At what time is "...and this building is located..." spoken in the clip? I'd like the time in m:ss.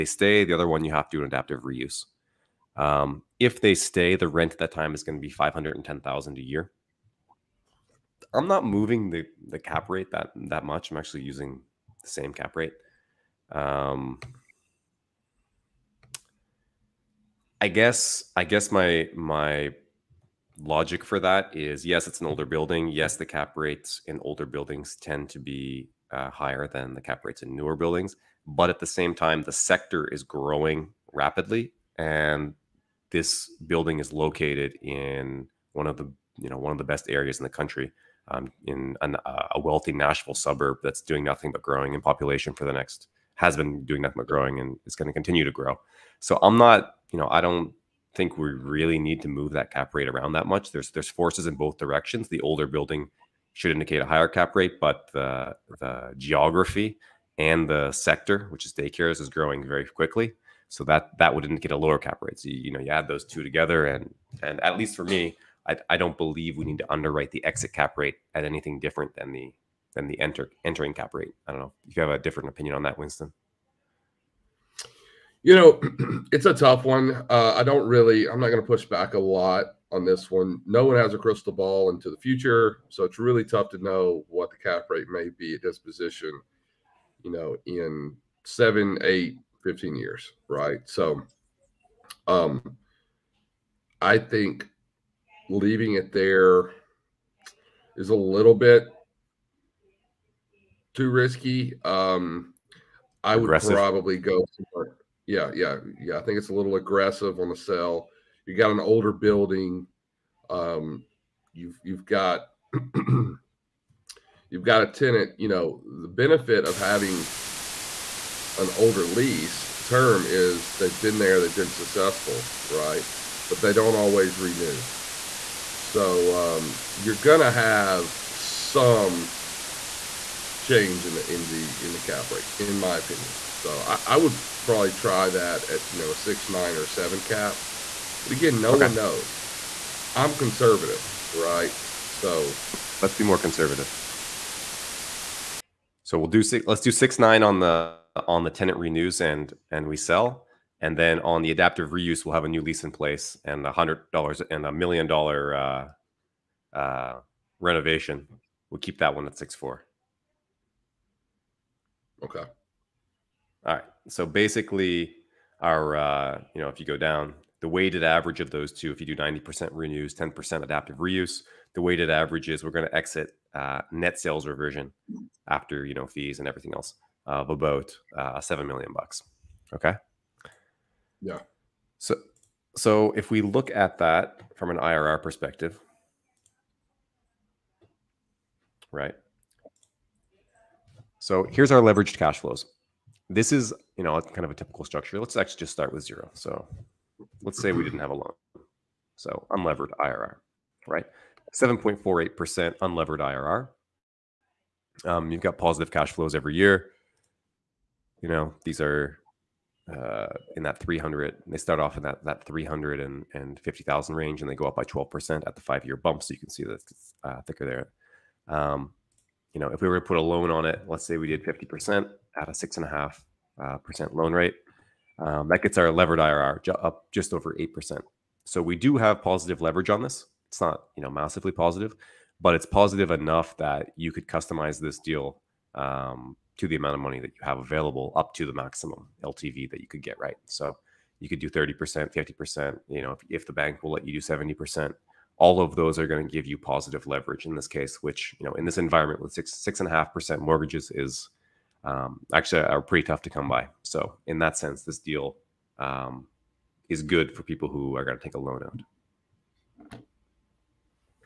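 0:31.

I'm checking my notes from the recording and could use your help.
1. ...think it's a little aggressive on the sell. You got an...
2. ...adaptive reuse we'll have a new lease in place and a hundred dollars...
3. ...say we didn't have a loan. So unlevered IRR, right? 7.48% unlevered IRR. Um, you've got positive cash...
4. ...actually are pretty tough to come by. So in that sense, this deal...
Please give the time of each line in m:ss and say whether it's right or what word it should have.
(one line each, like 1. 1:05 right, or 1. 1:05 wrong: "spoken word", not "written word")
1. 1:46 right
2. 2:31 right
3. 3:17 right
4. 4:12 right.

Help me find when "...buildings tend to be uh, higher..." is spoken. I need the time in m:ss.
0:24.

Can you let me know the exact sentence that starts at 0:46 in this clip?
So I'm not you know I don't think we really need to move that cap rate around that much.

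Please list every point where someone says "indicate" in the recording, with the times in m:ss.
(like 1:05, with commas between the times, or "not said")
0:53, 1:01.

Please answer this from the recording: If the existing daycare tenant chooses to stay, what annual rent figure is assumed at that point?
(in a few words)
$510,000.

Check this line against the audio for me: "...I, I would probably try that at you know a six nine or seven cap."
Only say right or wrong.
right.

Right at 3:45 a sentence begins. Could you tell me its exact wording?
Um, that gets our levered IRR up just over eight percent.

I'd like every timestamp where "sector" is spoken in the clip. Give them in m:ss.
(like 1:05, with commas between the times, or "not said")
0:29, 0:57.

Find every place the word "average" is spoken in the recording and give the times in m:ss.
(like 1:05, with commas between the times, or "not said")
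2:48, 2:52.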